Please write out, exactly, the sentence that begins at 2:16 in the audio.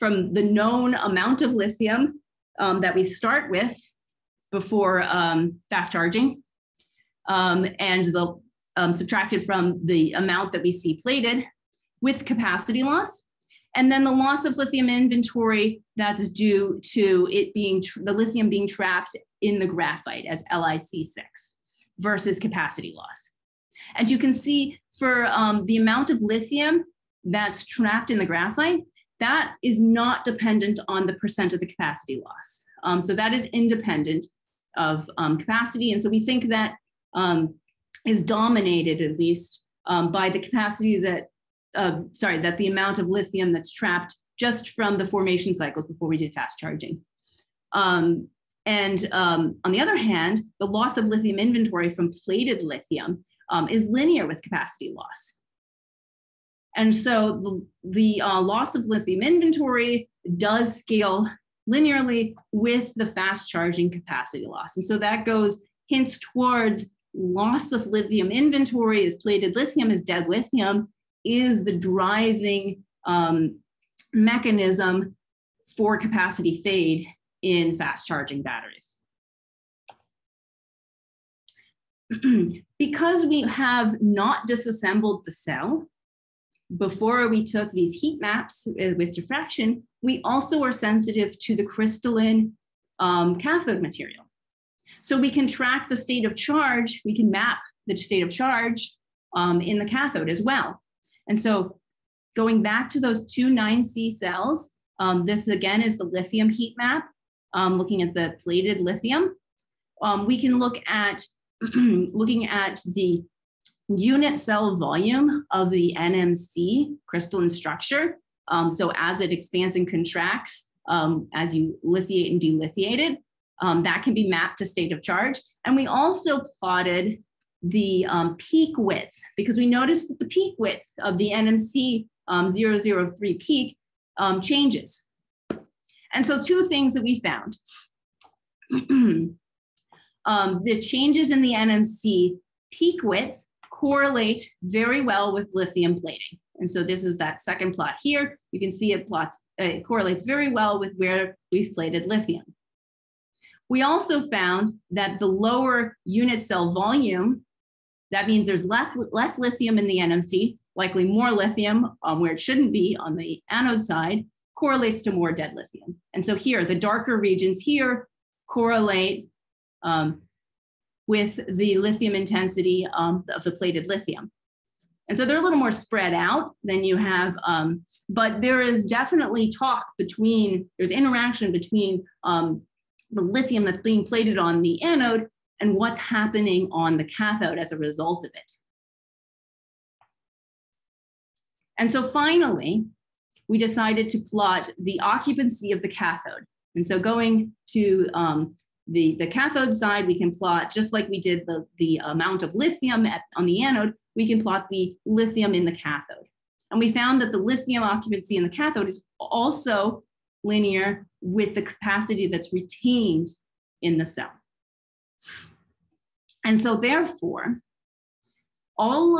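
And so two things that we found.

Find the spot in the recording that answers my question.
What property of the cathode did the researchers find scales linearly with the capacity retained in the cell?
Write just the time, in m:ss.
3:27.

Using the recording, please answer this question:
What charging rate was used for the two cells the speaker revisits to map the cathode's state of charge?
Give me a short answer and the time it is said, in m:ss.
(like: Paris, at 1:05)
9C, at 1:43.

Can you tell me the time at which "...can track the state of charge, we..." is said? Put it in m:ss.
1:35.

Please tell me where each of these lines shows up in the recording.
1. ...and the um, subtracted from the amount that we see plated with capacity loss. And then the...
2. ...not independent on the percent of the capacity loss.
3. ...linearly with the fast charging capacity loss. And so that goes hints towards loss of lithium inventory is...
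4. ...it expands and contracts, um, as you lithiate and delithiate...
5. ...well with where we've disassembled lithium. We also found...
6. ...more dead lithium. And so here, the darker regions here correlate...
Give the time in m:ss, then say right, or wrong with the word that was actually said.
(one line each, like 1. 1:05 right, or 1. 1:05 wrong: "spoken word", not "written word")
1. 0:07 right
2. 0:29 wrong: "dependent", not "independent"
3. 1:01 right
4. 1:59 right
5. 2:30 wrong: "plated", not "disassembled"
6. 2:45 right.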